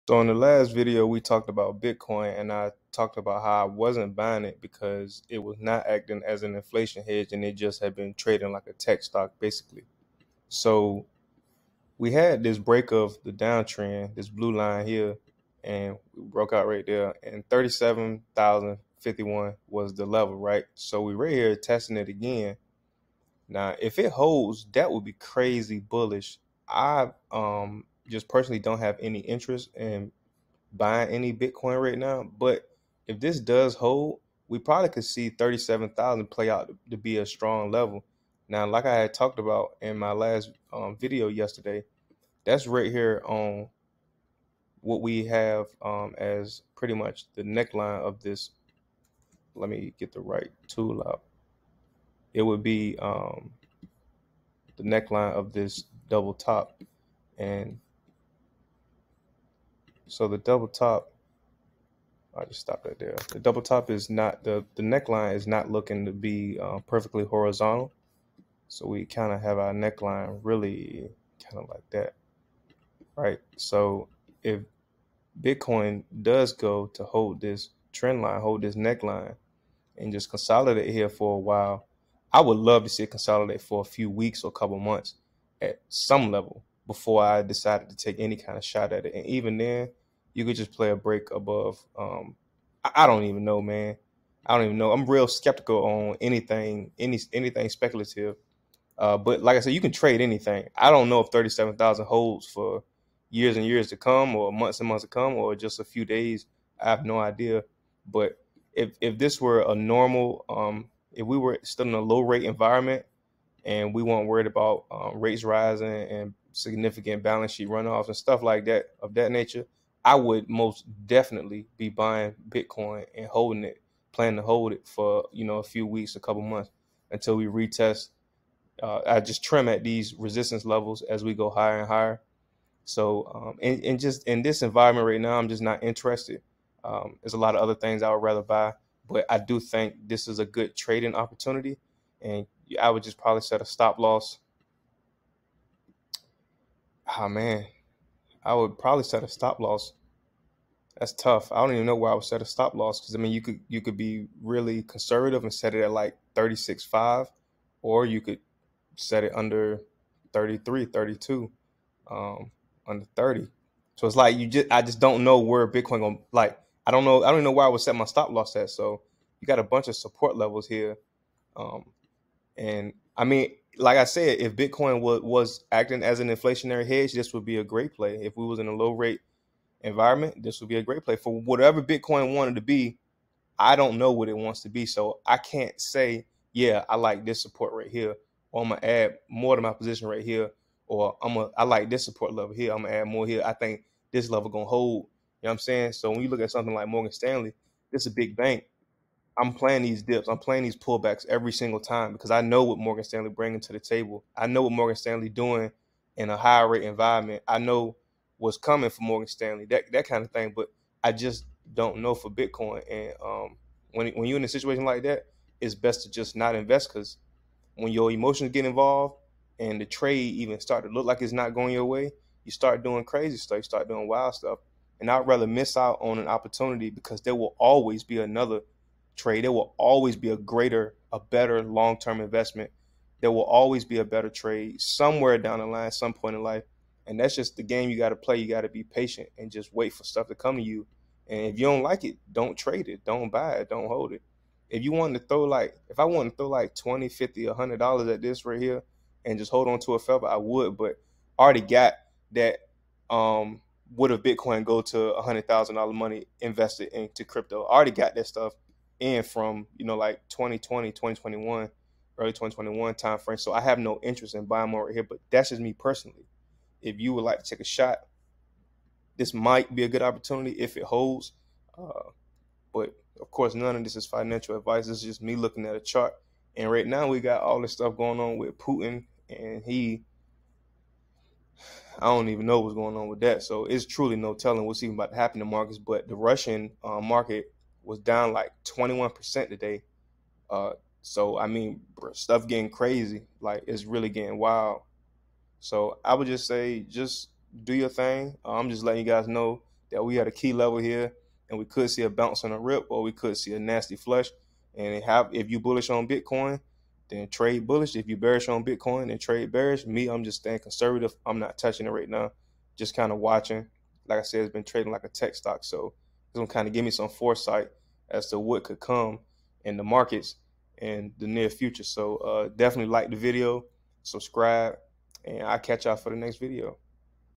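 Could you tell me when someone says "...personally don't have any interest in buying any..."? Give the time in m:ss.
0:28.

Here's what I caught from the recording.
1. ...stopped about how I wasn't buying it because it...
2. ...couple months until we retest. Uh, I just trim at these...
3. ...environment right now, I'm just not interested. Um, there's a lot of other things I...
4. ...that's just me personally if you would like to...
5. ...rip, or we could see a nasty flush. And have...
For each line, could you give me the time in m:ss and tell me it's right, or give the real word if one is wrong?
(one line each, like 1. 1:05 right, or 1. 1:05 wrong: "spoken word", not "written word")
1. 0:02 wrong: "talked", not "stopped"
2. 2:06 right
3. 2:14 right
4. 4:25 right
5. 5:02 right.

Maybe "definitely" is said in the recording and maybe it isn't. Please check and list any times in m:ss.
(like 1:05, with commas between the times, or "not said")
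2:01, 5:22.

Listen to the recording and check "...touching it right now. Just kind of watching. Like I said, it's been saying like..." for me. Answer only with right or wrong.
wrong.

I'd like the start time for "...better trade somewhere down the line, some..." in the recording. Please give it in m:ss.
3:54.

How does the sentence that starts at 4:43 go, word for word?
So it's truly no telling what's even about to happen to markets.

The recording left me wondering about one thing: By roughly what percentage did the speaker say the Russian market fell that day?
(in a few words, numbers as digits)
21%.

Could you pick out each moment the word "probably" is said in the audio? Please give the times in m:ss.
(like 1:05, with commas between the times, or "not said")
0:34, 2:23, 2:28.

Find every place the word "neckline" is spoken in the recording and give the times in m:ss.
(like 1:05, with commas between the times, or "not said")
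0:47, 0:54, 1:04, 1:09, 1:18.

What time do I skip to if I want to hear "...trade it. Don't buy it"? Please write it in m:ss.
4:02.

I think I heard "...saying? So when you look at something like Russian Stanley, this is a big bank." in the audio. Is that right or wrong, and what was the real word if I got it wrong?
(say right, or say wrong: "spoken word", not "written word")
wrong: "Morgan", not "Russian".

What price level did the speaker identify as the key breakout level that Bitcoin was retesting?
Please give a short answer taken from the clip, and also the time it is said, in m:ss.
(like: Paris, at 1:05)
37,051, at 0:17.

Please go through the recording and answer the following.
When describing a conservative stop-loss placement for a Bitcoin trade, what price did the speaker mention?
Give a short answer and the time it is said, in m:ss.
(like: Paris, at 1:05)
36.5, at 2:36.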